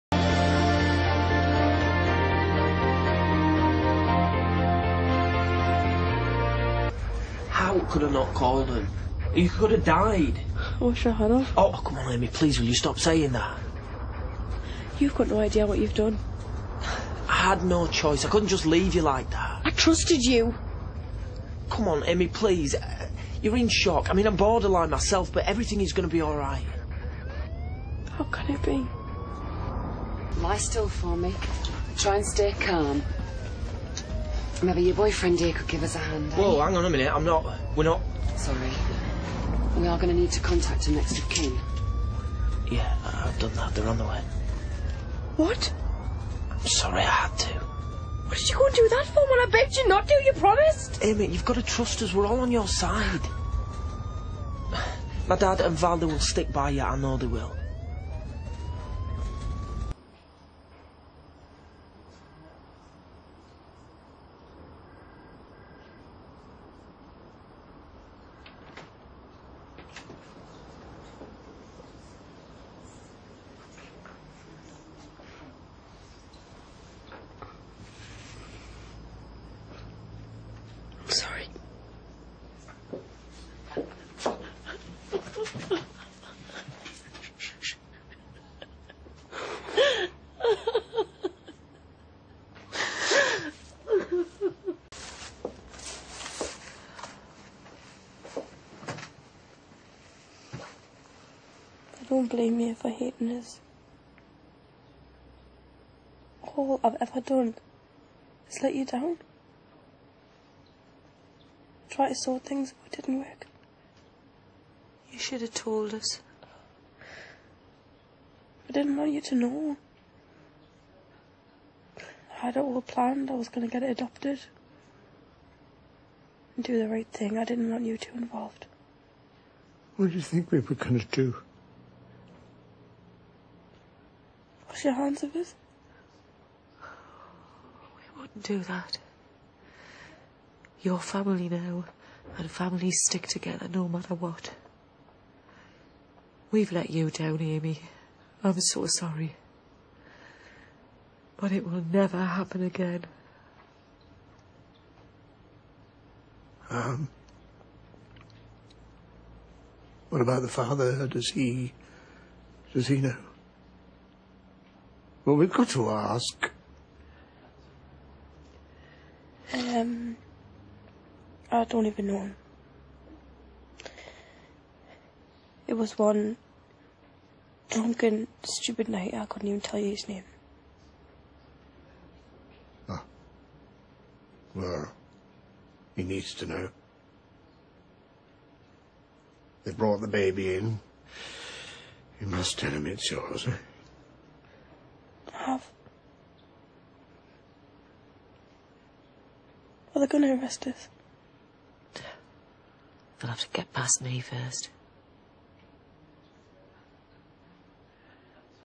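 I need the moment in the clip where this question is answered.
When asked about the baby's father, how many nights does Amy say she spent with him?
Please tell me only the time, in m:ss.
2:55.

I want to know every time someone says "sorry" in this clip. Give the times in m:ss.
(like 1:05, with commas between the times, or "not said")
0:38, 0:46, 2:28.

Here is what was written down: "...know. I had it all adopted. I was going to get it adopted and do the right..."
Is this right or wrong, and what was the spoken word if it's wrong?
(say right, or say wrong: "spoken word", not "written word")
wrong: "planned", not "adopted".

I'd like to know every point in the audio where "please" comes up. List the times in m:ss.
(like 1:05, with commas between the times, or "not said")
0:12, 0:22.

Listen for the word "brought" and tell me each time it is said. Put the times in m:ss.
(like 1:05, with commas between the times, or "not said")
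3:09.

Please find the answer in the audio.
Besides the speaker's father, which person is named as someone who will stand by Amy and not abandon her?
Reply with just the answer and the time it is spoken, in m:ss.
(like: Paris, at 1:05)
Valda, at 0:55.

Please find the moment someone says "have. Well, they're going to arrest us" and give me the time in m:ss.
3:15.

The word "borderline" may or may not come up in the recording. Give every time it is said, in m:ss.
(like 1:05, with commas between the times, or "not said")
0:24.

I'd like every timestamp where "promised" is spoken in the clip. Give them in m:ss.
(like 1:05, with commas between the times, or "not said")
0:50.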